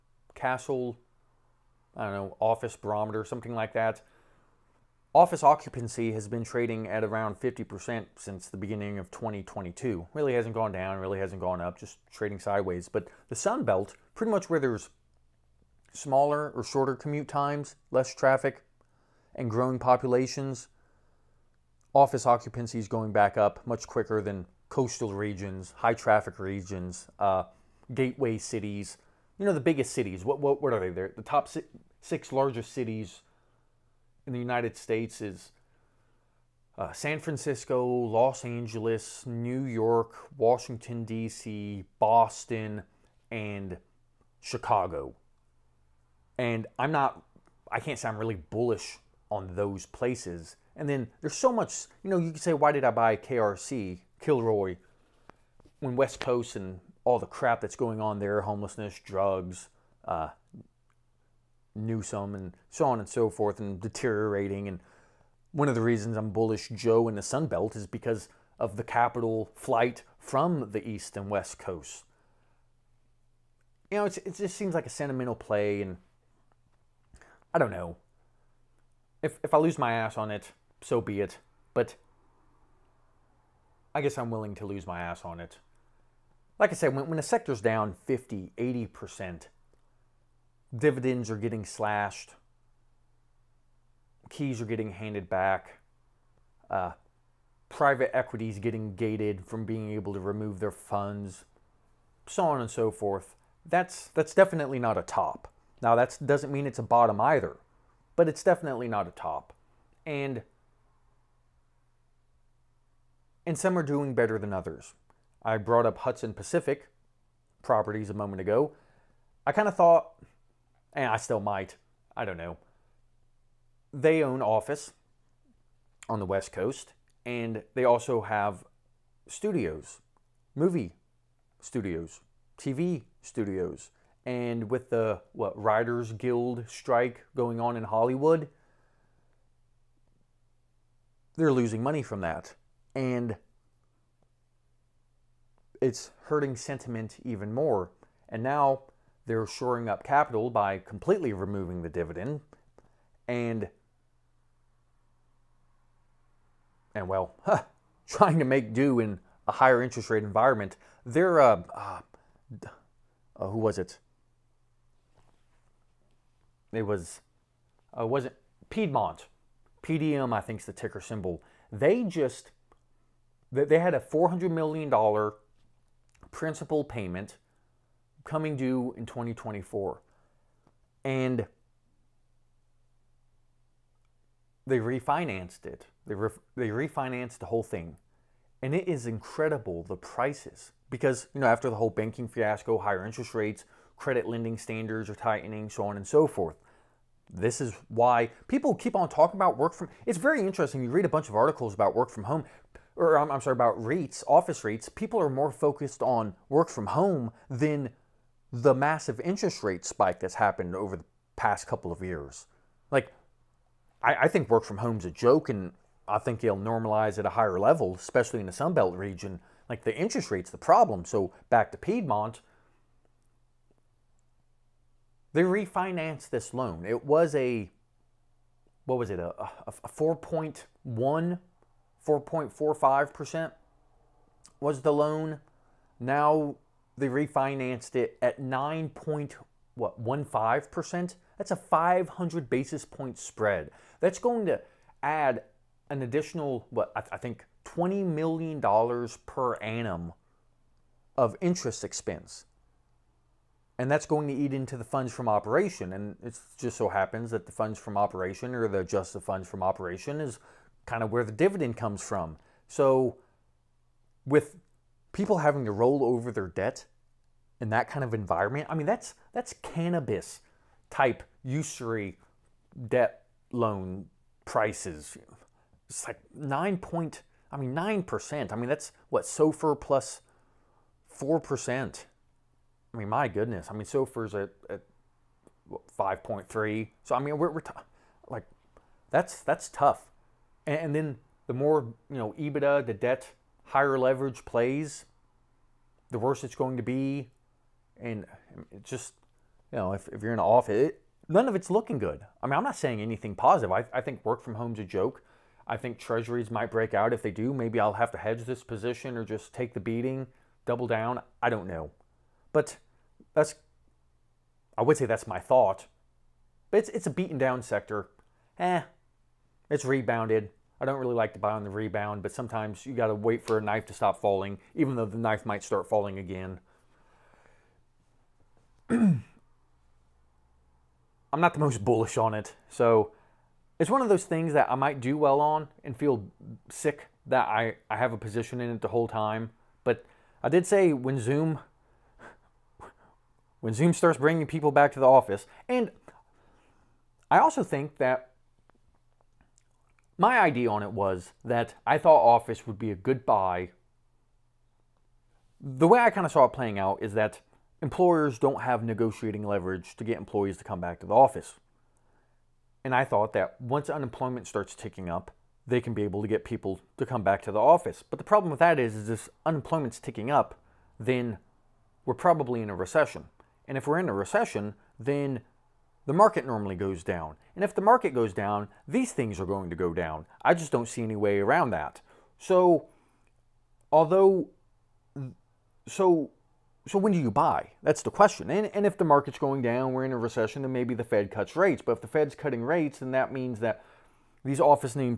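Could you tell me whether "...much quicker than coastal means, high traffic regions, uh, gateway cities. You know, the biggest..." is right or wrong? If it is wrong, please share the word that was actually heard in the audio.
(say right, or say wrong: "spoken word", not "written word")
wrong: "regions", not "means".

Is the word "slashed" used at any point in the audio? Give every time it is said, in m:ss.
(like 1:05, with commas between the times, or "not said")
1:31.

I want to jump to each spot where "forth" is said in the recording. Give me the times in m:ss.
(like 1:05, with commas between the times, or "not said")
1:03, 1:42, 3:16.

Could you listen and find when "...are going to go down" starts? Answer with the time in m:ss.
6:19.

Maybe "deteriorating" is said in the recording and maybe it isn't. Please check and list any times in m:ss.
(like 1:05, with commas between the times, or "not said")
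1:03.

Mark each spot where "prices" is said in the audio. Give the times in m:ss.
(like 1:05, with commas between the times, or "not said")
3:09, 4:34.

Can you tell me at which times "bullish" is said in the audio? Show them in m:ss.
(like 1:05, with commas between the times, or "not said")
0:48, 1:06, 5:31.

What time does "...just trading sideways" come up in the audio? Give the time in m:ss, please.
0:11.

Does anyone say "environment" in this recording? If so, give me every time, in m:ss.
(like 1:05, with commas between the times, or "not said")
2:40, 4:28.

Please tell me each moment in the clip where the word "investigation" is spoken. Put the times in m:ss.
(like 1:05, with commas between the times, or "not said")
not said.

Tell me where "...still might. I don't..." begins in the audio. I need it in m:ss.
2:01.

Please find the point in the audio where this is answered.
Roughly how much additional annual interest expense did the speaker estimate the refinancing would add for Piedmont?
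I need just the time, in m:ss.
4:07.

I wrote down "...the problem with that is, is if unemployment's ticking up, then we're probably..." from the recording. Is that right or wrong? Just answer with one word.
right.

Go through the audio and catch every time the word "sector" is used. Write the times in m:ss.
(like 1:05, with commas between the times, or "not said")
1:27, 5:17.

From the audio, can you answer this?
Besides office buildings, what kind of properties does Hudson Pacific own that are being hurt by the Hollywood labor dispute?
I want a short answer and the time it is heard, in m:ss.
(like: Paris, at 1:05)
movie studios, at 2:10.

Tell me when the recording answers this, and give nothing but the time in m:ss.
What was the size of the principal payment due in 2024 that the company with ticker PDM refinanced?
2:54.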